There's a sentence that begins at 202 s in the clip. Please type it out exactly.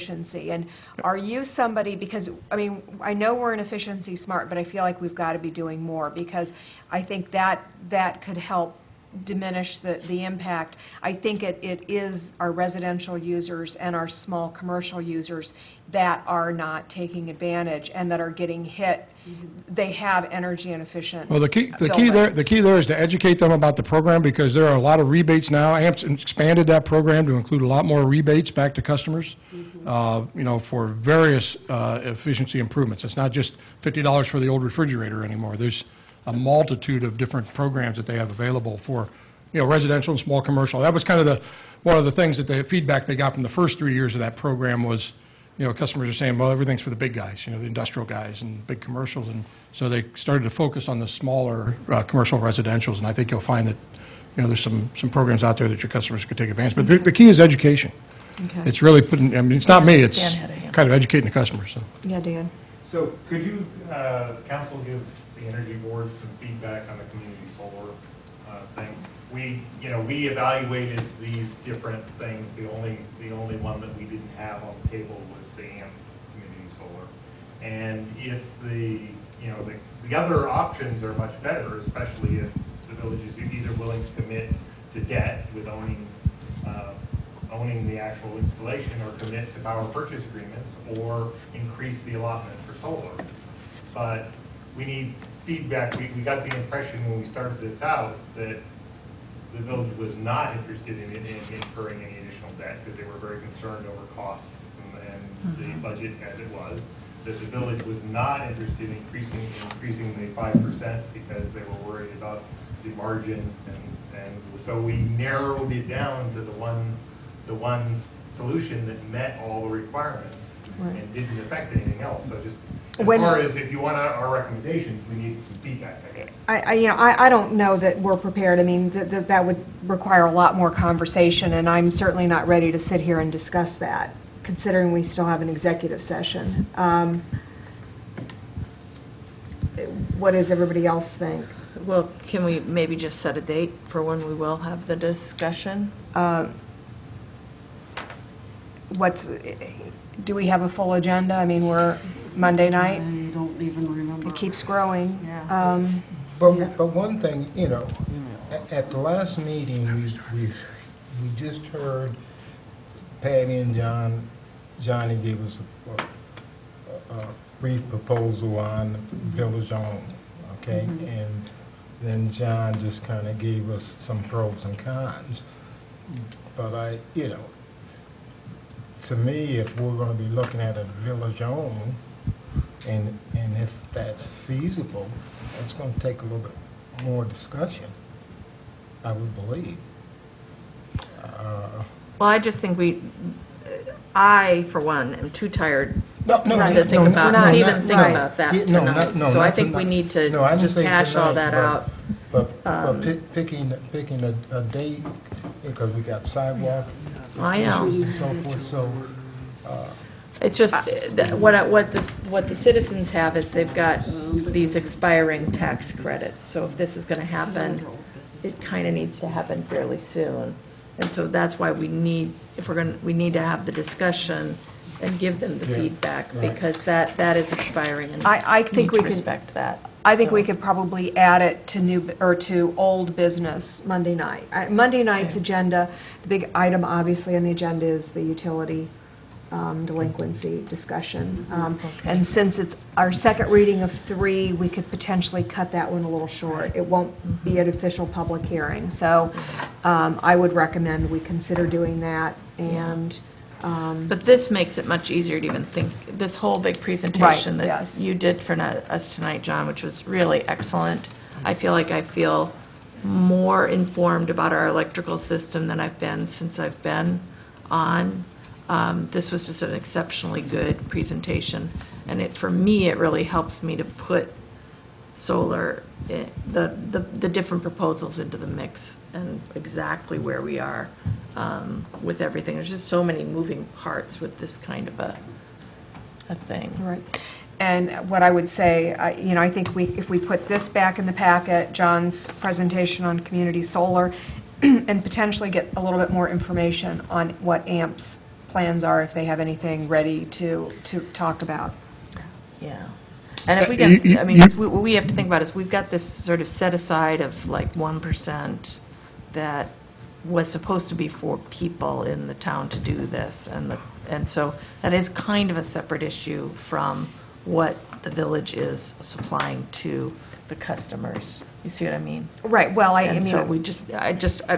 But, but um, picking, picking a, a date, because we got sidewalk I know.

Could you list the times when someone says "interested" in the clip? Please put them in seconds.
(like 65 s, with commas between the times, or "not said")
100 s, 108 s.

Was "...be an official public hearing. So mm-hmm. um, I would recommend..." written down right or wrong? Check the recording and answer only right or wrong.
right.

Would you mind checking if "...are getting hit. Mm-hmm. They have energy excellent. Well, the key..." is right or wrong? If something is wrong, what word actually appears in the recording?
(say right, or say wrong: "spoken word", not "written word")
wrong: "inefficient", not "excellent".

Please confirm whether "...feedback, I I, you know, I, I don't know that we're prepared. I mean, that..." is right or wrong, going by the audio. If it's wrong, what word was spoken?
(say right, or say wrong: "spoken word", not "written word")
right.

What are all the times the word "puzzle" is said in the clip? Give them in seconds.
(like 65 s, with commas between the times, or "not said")
not said.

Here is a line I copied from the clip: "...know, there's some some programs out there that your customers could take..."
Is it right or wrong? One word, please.
right.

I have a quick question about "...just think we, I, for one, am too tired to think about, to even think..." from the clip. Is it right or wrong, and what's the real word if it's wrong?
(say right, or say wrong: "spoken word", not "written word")
right.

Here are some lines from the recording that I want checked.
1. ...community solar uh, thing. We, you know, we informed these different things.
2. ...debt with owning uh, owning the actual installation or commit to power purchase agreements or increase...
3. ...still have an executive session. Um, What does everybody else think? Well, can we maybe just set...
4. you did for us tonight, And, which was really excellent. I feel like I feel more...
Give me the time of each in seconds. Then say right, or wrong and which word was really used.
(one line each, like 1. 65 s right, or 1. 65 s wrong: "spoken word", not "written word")
1. 67 s wrong: "evaluated", not "informed"
2. 85 s right
3. 135 s right
4. 258 s wrong: "John", not "And".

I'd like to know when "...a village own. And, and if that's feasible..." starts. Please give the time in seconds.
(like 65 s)
180 s.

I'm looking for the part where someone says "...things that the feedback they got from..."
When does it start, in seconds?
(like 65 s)
42 s.